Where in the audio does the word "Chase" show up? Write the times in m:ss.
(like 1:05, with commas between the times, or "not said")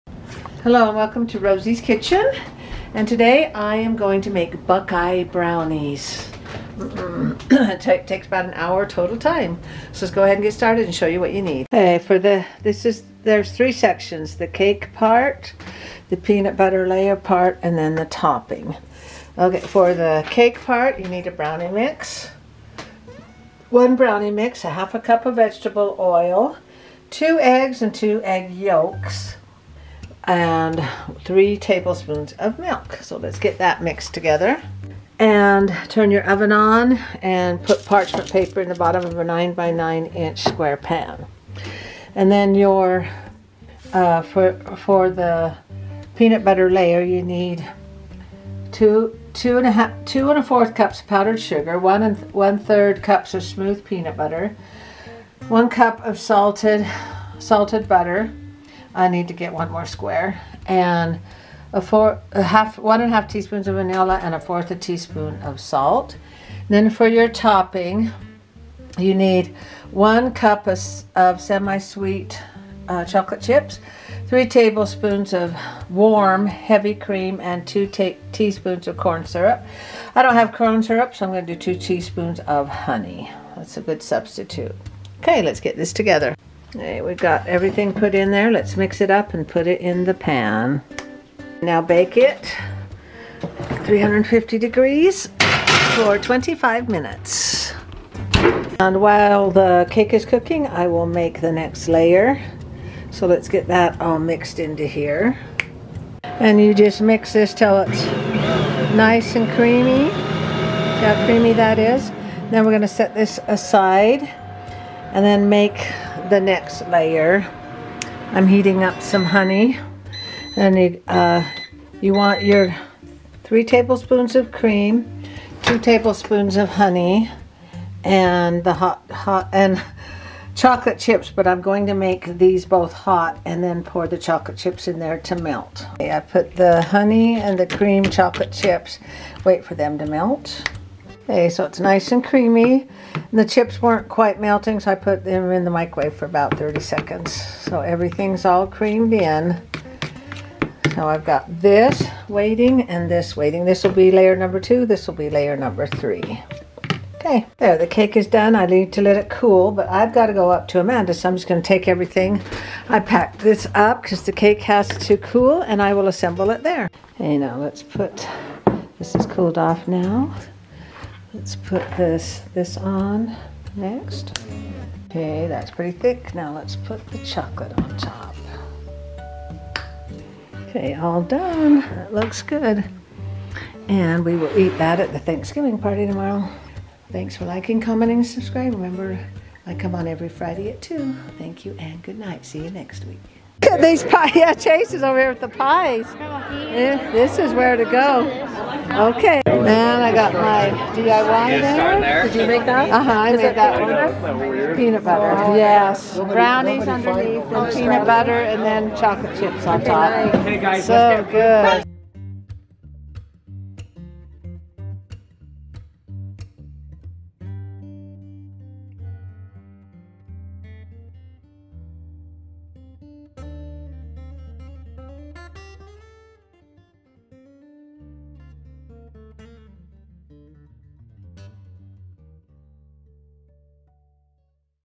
3:14.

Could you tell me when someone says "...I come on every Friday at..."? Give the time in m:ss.
3:09.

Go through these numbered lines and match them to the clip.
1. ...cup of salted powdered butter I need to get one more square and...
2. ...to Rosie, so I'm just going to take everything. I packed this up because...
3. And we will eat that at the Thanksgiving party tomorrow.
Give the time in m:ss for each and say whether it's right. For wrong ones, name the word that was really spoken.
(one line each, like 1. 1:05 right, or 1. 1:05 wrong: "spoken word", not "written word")
1. 0:55 wrong: "salted", not "powdered"
2. 2:40 wrong: "Amanda", not "Rosie"
3. 3:03 right.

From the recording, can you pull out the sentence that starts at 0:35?
And turn your oven on and put parchment paper in the bottom of a 9 by 9 inch square pan.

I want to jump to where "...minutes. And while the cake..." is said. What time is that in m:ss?
1:36.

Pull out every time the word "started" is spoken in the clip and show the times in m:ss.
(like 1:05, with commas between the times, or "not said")
0:10.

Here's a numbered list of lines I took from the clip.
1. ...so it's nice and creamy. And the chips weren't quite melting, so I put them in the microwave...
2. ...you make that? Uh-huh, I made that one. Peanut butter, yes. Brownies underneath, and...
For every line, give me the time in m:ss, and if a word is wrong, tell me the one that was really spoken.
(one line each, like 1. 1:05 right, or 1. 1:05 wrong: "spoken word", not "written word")
1. 2:21 right
2. 3:22 right.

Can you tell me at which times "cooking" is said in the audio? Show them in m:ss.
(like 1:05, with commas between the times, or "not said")
1:40.